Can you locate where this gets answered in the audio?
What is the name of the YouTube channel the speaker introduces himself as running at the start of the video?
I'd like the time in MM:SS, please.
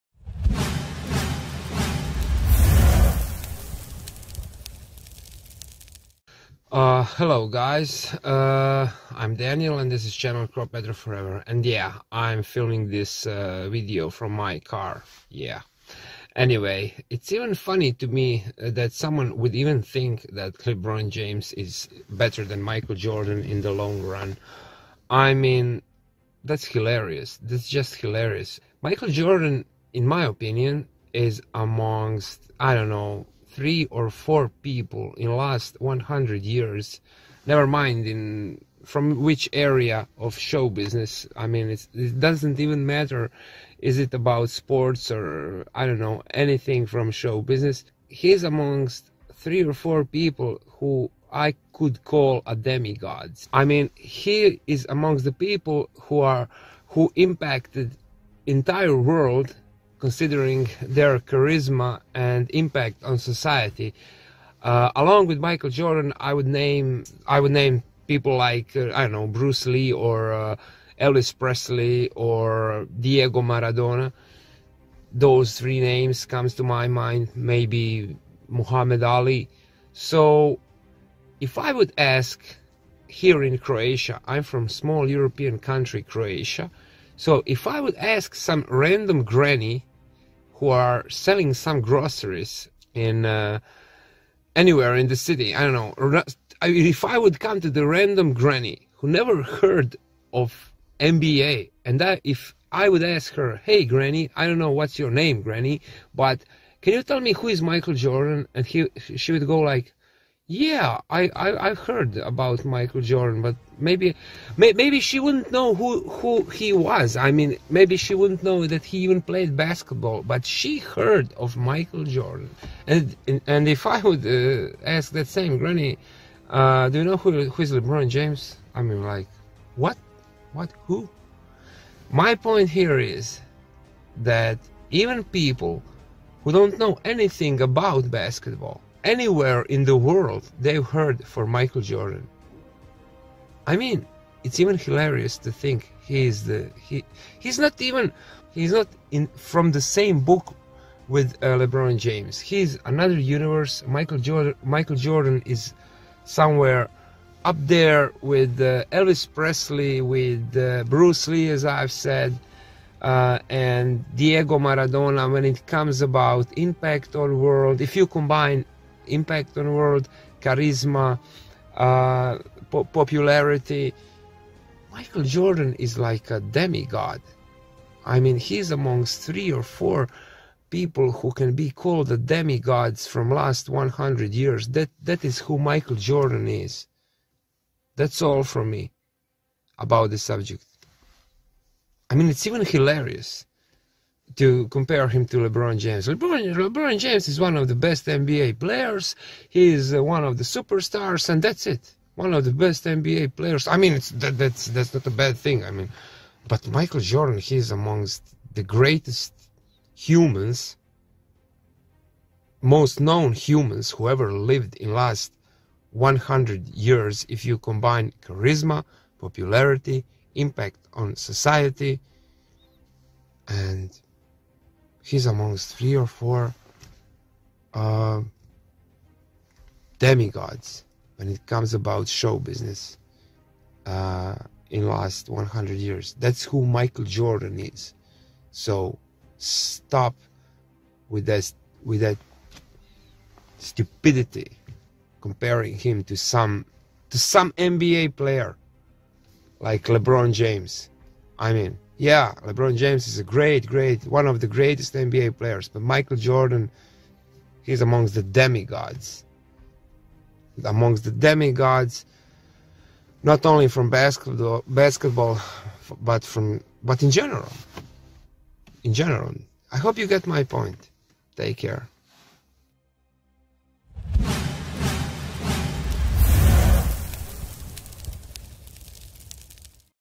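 00:10.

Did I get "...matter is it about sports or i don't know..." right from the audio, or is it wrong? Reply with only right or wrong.
right.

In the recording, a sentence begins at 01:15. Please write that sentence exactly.
Those three names comes to my mind.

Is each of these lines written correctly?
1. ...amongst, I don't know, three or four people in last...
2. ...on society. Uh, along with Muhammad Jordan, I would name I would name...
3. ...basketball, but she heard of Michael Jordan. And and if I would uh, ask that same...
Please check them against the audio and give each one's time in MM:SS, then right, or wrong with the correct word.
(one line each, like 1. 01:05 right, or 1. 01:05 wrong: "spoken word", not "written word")
1. 00:31 right
2. 01:03 wrong: "Michael", not "Muhammad"
3. 01:59 right.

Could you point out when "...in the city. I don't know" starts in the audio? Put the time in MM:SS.
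01:34.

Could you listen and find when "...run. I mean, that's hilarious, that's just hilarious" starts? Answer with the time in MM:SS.
00:24.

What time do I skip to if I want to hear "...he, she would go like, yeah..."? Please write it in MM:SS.
01:48.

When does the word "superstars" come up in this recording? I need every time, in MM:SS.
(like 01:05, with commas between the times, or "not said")
03:20.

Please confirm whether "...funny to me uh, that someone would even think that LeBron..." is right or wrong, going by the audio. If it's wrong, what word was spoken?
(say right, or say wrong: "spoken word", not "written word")
right.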